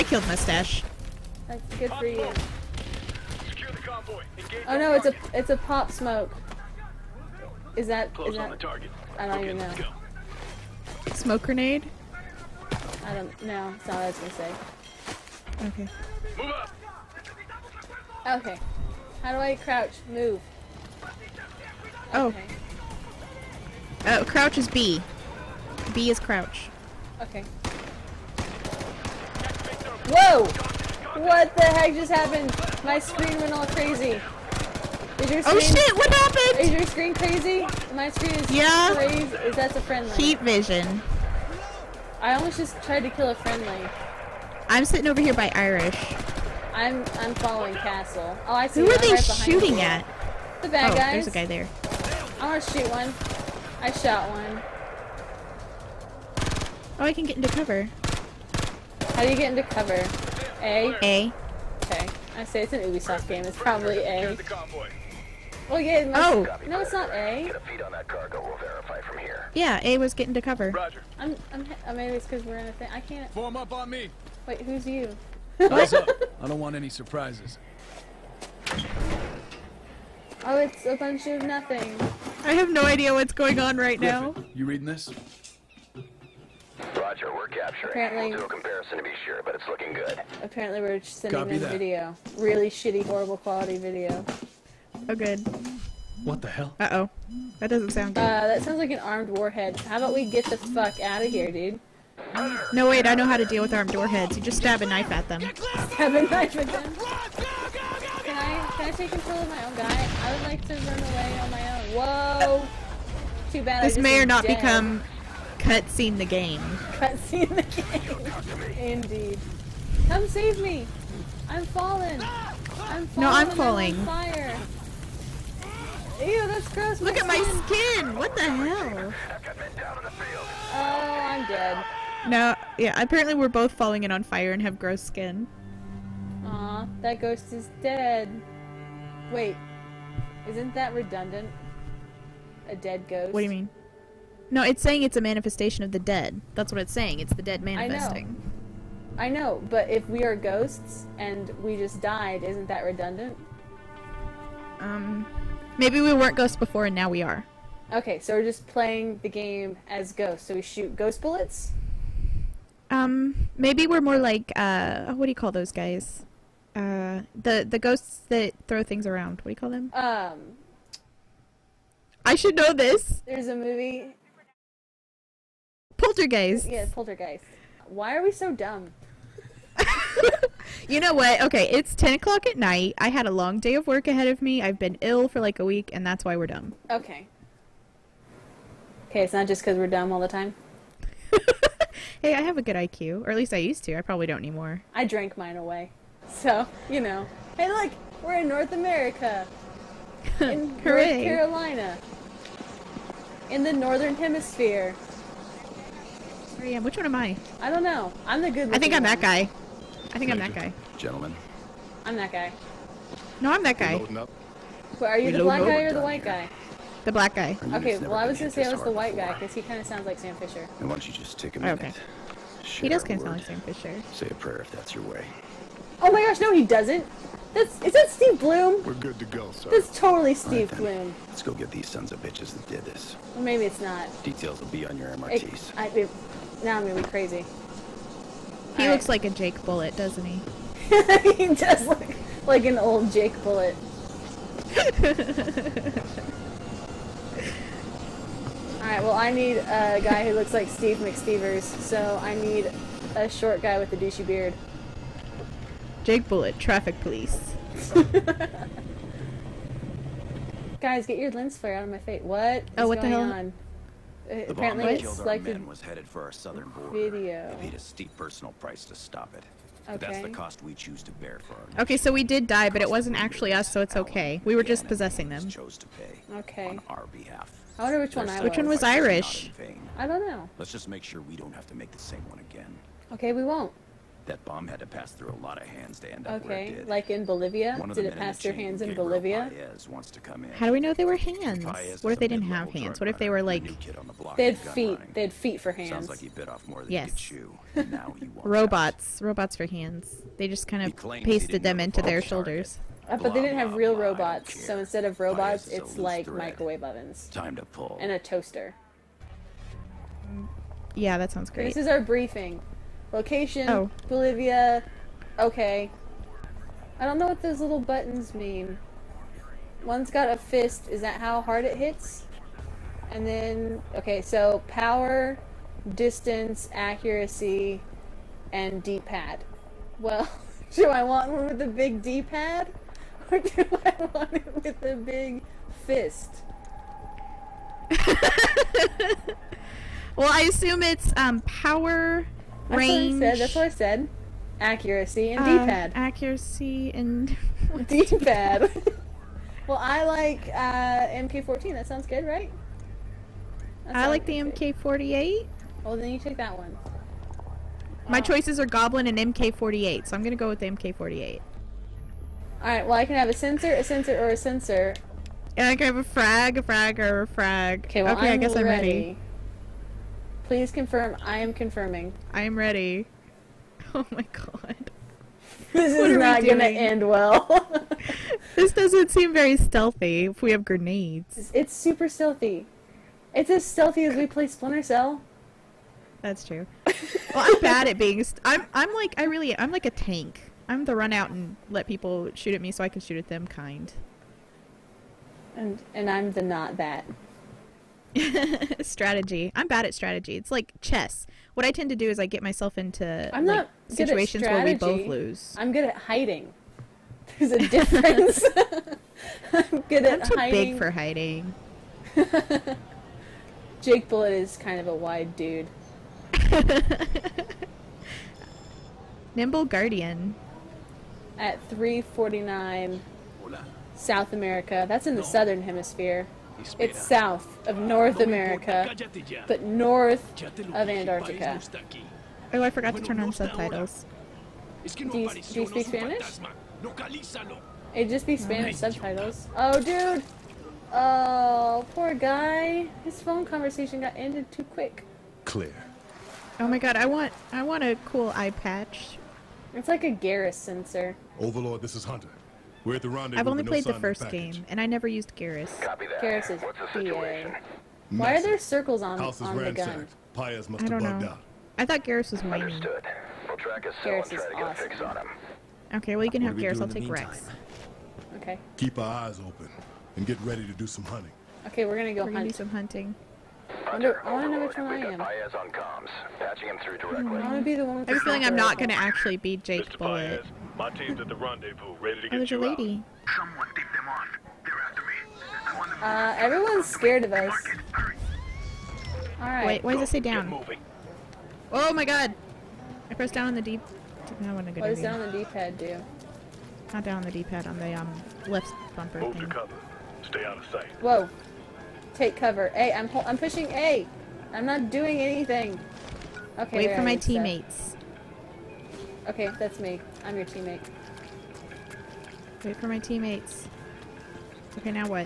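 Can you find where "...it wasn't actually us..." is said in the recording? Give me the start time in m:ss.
4:32.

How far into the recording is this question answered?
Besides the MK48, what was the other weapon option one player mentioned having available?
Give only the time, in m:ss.
5:58.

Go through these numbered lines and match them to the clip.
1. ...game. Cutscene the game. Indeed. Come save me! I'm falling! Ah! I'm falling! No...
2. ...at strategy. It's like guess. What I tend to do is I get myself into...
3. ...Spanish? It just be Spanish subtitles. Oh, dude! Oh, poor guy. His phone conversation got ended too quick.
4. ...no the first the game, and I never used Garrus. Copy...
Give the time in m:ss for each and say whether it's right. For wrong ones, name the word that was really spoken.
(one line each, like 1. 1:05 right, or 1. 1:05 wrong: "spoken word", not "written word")
1. 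1:56 right
2. 6:39 wrong: "chess", not "guess"
3. 7:15 right
4. 7:33 right.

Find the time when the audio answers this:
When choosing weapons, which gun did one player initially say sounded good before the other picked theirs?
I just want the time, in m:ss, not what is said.
5:51.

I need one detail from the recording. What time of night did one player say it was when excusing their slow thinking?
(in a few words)
10 o'clock.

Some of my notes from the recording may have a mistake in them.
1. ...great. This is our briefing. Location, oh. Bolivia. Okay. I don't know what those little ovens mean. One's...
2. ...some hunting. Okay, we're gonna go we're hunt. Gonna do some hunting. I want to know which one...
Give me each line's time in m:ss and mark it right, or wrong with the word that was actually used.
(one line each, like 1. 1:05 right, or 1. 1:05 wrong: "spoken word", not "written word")
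1. 5:11 wrong: "buttons", not "ovens"
2. 7:50 right.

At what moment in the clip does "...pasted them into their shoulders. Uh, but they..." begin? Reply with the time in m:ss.
5:01.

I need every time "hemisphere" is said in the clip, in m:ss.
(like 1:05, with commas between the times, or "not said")
3:24, 7:05.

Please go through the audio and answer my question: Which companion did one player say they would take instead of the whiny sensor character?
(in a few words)
Rex.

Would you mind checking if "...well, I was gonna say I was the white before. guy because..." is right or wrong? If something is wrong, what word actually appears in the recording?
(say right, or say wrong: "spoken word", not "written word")
right.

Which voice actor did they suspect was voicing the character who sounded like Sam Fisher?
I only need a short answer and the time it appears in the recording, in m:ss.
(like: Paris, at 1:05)
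Steve Blum, at 3:48.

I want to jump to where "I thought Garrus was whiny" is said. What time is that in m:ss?
7:41.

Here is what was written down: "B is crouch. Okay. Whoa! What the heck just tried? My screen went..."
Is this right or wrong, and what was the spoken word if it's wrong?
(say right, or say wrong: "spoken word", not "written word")
wrong: "happened", not "tried".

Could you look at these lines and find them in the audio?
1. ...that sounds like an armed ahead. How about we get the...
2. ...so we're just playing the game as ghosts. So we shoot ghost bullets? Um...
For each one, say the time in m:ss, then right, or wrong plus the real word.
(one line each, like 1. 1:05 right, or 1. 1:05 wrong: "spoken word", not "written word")
1. 1:38 wrong: "warhead", not "ahead"
2. 2:38 right.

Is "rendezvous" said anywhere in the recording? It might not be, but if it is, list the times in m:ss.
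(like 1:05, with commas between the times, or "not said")
7:33, 8:01.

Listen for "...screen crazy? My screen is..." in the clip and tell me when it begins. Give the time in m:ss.
0:36.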